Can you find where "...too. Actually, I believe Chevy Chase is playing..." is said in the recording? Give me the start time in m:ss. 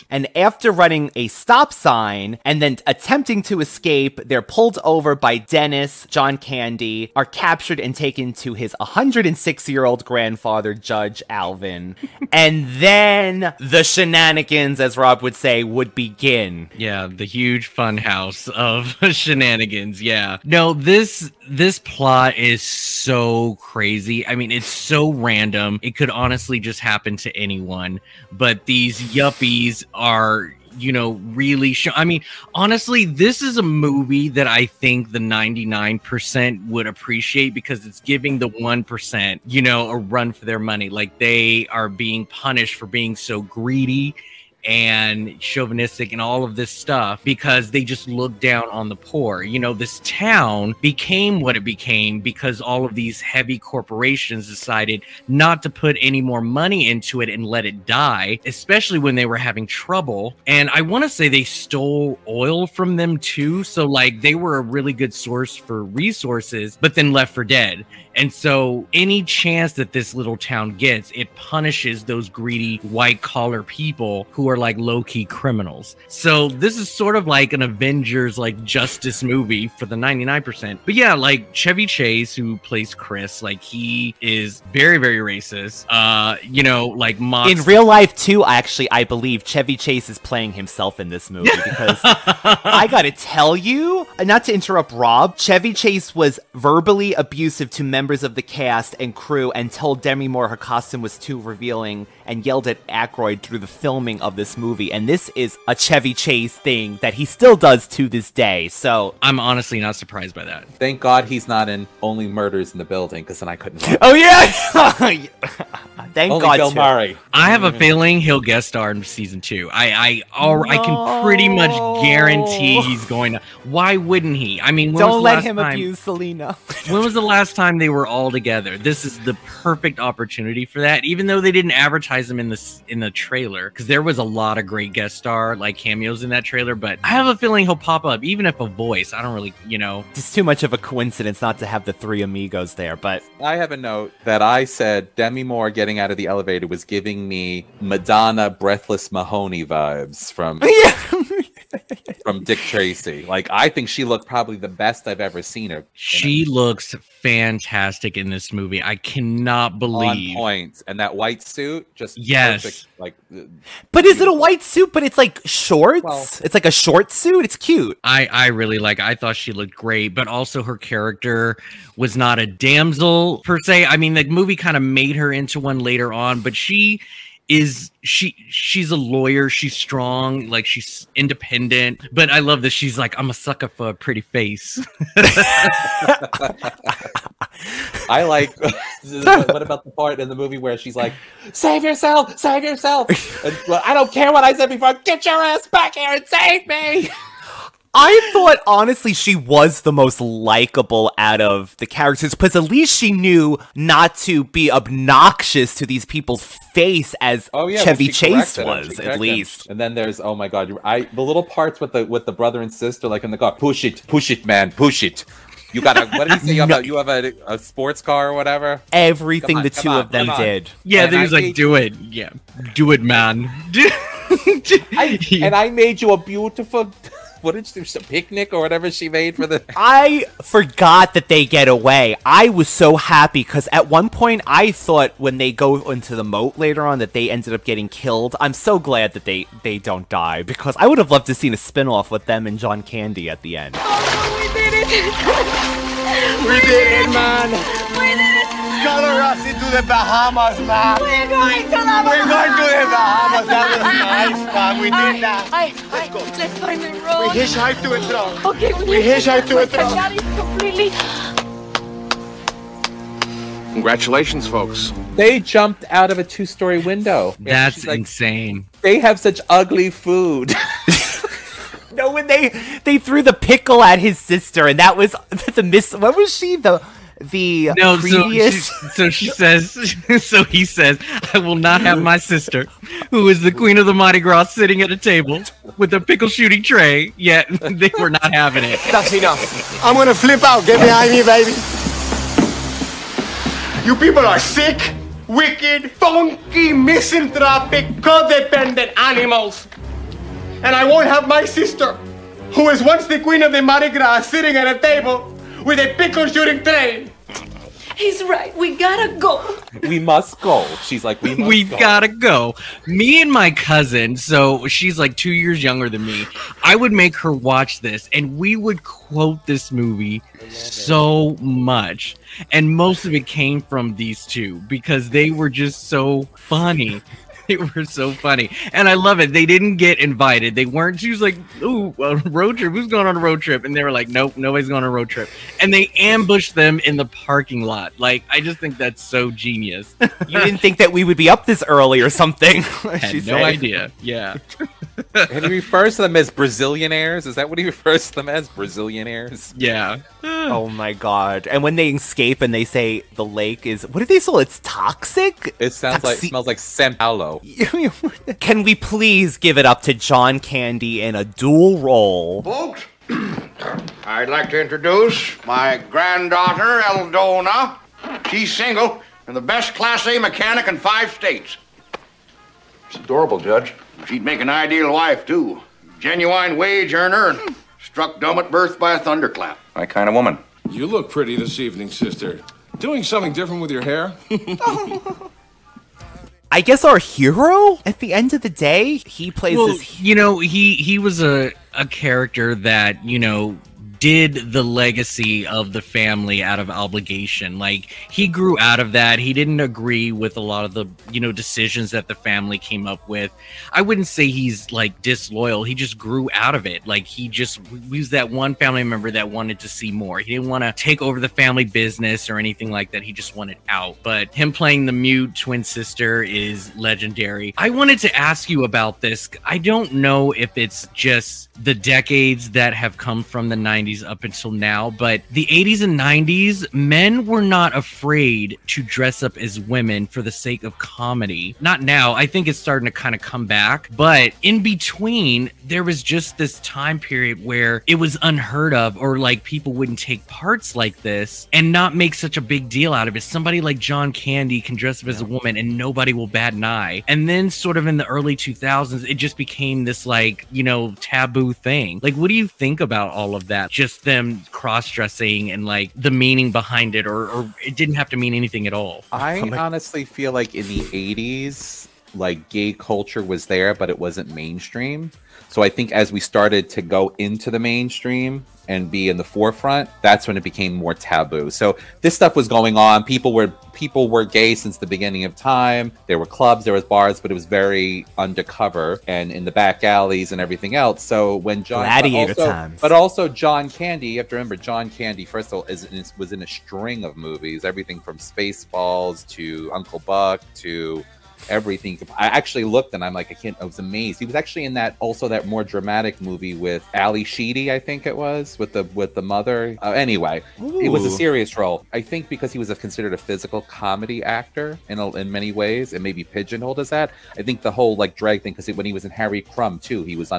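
1:28.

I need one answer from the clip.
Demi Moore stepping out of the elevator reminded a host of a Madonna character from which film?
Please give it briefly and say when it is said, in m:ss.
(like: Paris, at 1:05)
Dick Tracy, at 2:32.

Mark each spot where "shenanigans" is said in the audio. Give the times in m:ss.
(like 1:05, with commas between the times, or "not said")
0:13, 0:19.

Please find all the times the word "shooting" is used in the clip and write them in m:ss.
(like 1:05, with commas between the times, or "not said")
4:46, 5:06.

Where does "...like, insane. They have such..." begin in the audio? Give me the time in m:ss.
4:27.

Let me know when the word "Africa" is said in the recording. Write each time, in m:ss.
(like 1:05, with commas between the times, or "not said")
not said.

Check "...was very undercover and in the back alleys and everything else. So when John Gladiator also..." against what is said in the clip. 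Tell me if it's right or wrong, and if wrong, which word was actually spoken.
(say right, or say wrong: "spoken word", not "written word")
right.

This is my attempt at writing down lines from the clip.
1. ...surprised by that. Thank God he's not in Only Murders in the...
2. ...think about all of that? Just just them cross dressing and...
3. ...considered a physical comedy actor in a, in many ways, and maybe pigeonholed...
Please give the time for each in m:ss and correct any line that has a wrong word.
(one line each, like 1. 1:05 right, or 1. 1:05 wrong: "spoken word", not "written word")
1. 1:49 right
2. 7:32 right
3. 8:22 right.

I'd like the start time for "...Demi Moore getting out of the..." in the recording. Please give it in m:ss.
2:25.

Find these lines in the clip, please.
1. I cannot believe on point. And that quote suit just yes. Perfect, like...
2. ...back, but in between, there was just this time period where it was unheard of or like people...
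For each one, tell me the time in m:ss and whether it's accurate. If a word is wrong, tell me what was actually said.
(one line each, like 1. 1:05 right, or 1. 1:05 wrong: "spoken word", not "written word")
1. 2:38 wrong: "white", not "quote"
2. 7:13 right.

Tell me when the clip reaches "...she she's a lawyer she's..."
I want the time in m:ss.
2:58.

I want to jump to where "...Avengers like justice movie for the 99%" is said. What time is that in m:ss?
1:17.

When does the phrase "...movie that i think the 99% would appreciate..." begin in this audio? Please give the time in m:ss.
0:33.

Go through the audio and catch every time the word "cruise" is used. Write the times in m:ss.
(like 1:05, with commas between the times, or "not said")
not said.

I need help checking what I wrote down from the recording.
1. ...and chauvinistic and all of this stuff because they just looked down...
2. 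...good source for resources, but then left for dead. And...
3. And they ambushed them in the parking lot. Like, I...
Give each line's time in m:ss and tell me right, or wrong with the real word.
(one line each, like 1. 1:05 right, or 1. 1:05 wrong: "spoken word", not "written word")
1. 0:44 right
2. 1:04 right
3. 5:35 right.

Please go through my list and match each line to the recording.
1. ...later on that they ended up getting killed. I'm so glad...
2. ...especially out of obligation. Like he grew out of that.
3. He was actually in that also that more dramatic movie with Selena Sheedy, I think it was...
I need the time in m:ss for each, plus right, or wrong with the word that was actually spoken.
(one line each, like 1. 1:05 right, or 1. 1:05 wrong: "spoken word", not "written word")
1. 3:56 right
2. 6:35 wrong: "family", not "especially"
3. 8:14 wrong: "Ally", not "Selena".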